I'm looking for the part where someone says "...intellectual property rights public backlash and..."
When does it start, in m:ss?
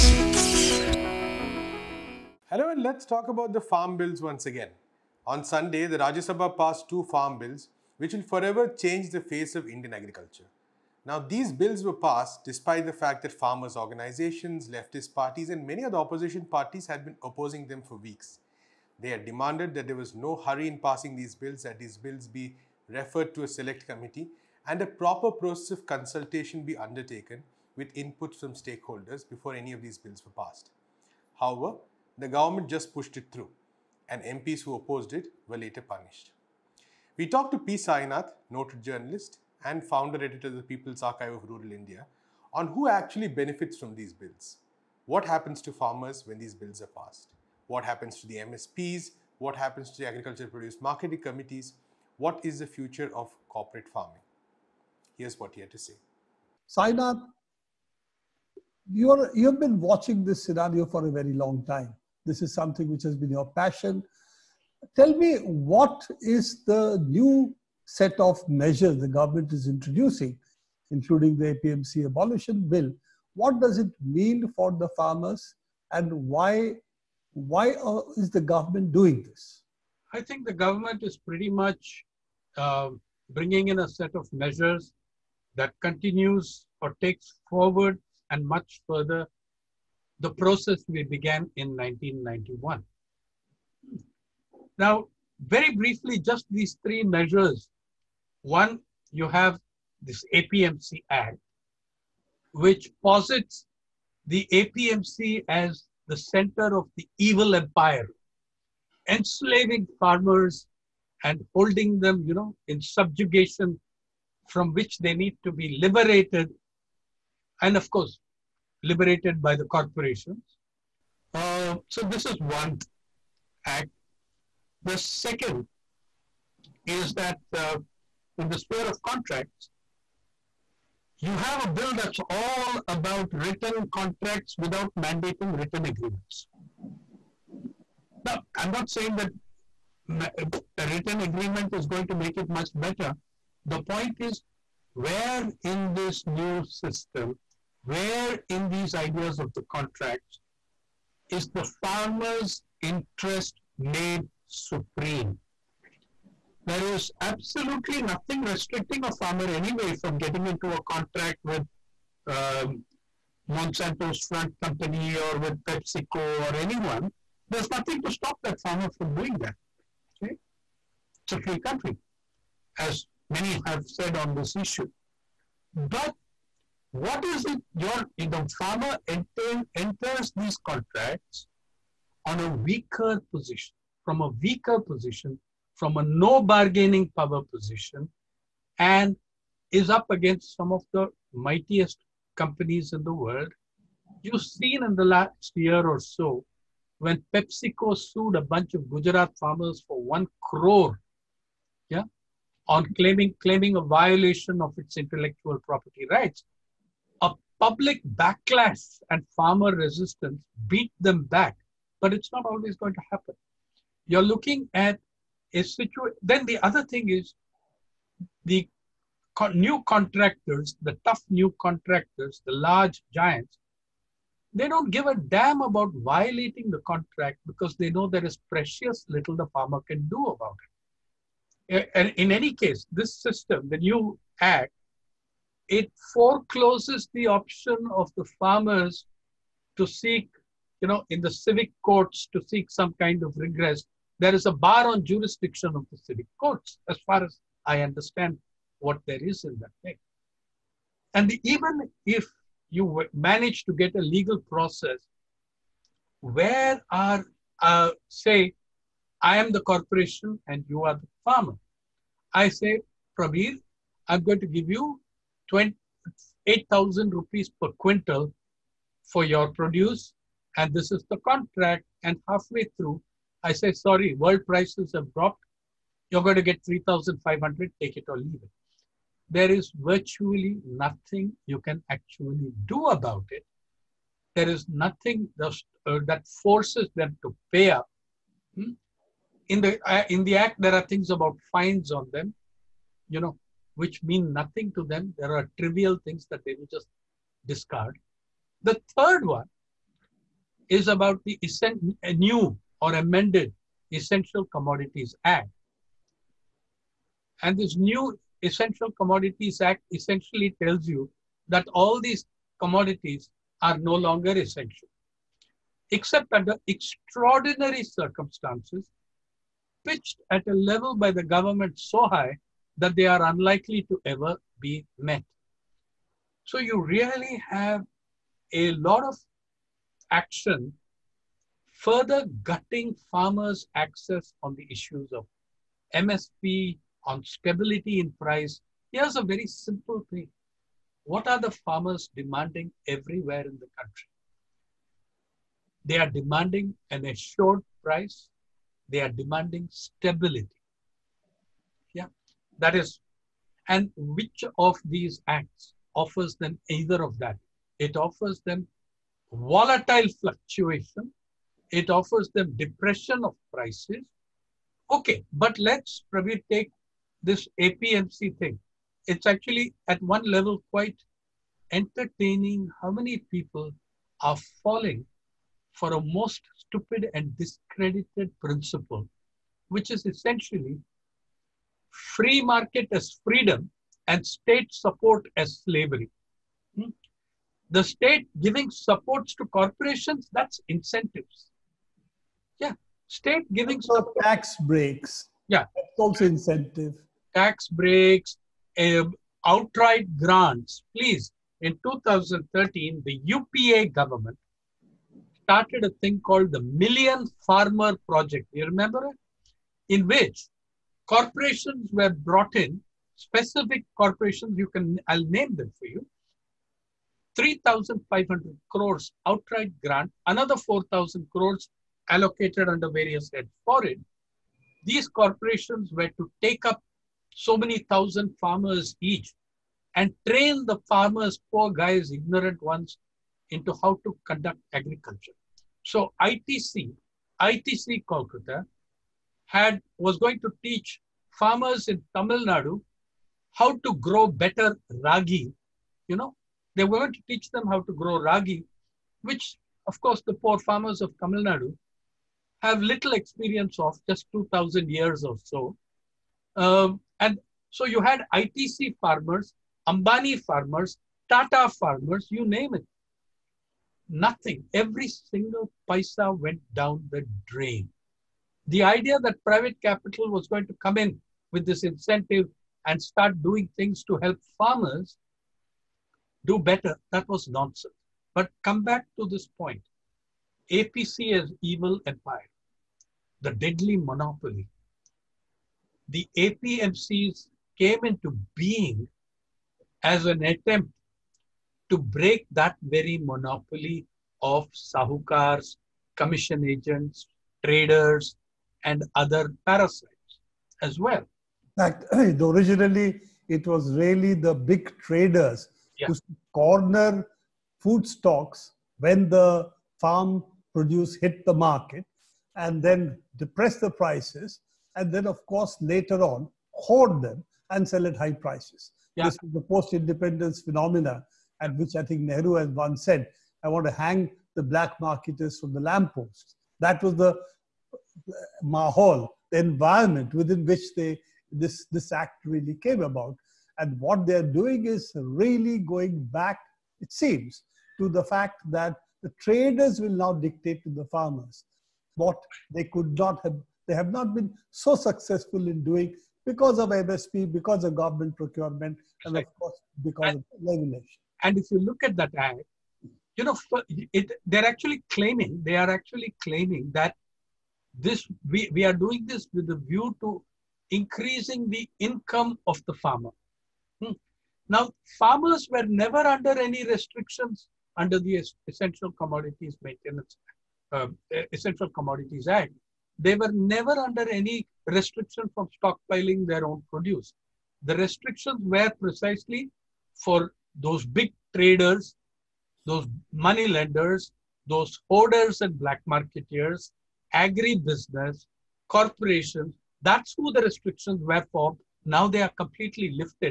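3:24.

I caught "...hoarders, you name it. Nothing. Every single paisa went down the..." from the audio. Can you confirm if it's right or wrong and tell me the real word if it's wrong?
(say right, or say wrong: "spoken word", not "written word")
wrong: "farmers", not "hoarders".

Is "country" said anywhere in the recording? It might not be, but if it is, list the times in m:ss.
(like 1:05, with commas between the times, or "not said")
2:51, 5:43.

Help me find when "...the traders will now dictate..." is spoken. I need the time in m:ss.
8:59.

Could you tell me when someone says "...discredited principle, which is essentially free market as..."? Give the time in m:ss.
6:17.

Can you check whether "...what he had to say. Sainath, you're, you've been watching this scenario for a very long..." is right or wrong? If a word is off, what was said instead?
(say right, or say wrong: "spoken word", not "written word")
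right.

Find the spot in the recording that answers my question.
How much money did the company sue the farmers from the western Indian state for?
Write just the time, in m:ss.
3:20.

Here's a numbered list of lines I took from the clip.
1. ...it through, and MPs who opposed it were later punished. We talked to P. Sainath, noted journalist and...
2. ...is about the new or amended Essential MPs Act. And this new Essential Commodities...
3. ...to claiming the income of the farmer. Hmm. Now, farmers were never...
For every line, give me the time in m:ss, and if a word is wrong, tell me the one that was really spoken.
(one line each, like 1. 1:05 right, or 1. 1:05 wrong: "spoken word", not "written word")
1. 0:33 right
2. 5:00 wrong: "Commodities", not "MPs"
3. 9:20 wrong: "increasing", not "claiming".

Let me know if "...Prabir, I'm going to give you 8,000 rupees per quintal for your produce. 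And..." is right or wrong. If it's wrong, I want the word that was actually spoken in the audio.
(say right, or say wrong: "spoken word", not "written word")
right.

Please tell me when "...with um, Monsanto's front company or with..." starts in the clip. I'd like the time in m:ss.
2:41.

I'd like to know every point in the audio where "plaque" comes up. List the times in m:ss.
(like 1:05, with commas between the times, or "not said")
not said.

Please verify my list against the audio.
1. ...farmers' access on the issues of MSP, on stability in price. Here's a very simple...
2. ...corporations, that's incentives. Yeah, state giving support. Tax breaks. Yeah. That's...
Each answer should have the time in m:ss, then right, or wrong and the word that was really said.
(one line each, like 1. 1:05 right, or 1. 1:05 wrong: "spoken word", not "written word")
1. 5:33 right
2. 6:29 right.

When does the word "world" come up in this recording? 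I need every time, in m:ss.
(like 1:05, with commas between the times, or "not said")
3:13, 4:34.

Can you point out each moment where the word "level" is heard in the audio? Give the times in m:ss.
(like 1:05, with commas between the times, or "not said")
5:20, 6:10.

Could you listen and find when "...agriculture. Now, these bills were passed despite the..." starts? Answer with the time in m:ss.
0:09.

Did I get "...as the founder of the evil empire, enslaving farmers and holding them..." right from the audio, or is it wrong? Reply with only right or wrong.
wrong.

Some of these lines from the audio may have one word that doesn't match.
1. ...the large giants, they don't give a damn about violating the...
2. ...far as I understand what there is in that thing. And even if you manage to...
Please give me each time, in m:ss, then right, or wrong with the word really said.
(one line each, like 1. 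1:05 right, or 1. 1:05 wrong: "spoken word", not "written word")
1. 3:42 right
2. 4:07 right.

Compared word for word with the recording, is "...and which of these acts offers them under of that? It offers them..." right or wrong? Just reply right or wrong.
wrong.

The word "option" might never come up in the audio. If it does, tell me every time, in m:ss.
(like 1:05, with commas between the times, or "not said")
3:57.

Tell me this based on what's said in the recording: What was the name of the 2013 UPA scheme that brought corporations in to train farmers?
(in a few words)
Million Farmer Project.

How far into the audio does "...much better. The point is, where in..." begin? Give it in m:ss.
2:22.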